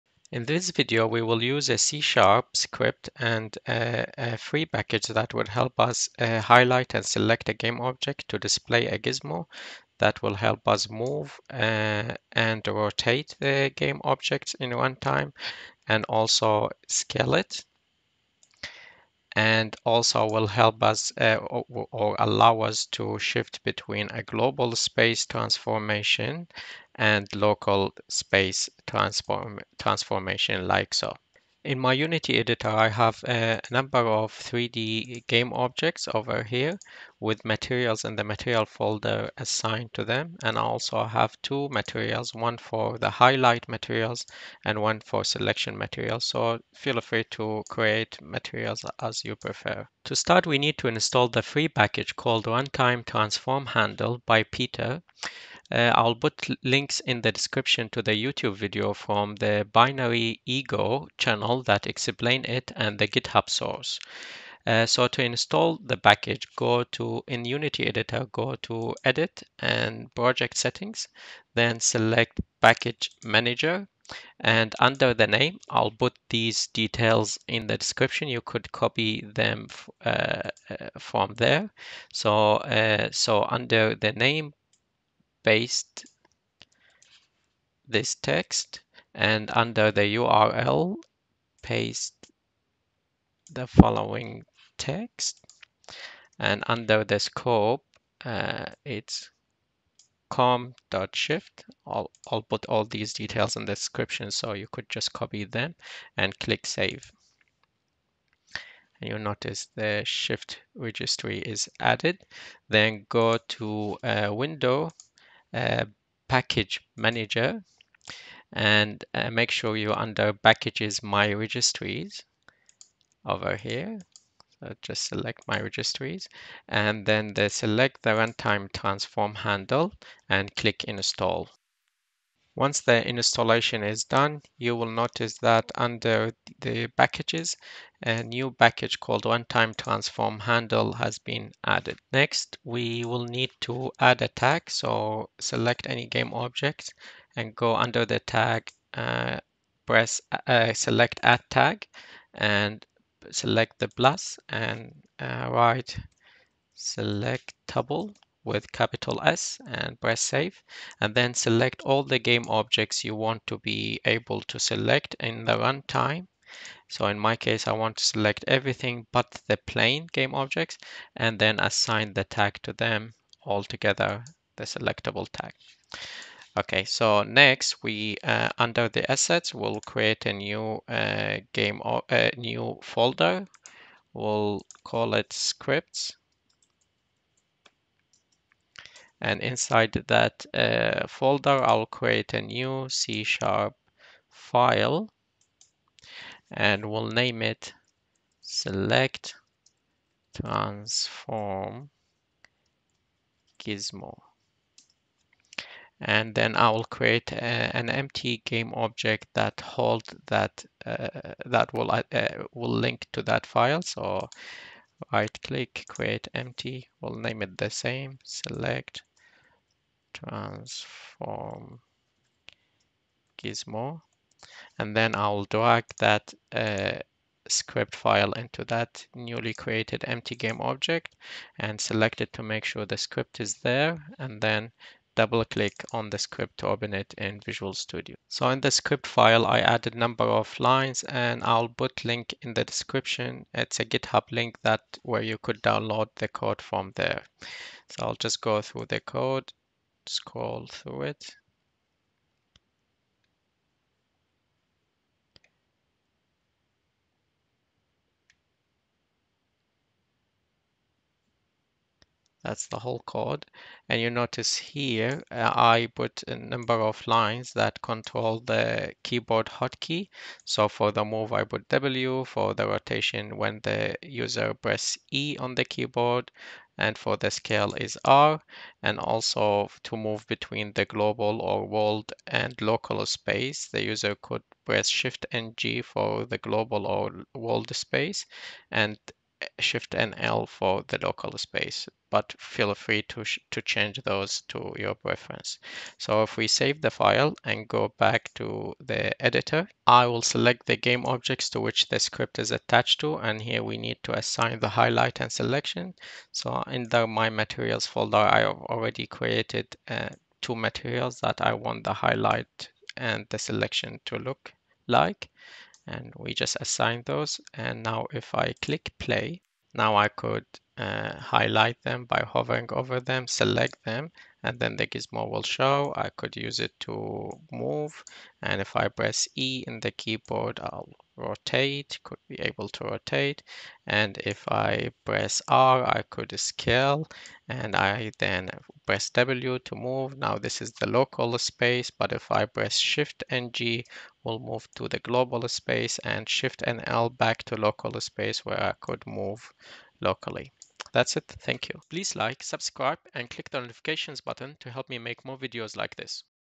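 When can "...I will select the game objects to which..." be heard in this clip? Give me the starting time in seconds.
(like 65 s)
299 s.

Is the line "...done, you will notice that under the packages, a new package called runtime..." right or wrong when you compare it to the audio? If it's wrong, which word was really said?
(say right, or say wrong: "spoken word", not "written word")
right.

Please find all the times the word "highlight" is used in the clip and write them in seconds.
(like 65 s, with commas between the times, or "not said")
6 s, 43 s, 304 s, 311 s, 321 s.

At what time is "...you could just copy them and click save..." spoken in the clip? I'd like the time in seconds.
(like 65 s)
104 s.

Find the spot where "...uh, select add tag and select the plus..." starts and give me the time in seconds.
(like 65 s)
150 s.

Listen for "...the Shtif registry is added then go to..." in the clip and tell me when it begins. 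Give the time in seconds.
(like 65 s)
109 s.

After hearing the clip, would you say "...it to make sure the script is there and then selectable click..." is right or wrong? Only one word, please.
wrong.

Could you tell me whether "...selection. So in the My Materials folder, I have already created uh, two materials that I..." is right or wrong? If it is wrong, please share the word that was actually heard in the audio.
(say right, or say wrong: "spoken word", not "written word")
right.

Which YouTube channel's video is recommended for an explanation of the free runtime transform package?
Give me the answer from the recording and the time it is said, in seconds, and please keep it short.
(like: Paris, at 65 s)
Binary Ego, at 59 s.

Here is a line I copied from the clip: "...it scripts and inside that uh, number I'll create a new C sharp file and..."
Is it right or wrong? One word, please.
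wrong.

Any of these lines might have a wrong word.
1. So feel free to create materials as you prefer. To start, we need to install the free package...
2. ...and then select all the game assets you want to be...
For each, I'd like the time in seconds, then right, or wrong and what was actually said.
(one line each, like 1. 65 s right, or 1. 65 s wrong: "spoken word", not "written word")
1. 46 s right
2. 160 s wrong: "objects", not "assets".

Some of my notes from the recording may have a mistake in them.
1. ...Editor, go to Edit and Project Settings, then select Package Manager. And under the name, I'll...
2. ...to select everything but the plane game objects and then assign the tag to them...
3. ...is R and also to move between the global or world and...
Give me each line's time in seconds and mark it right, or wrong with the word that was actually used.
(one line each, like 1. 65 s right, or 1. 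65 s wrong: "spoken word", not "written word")
1. 67 s right
2. 167 s right
3. 277 s right.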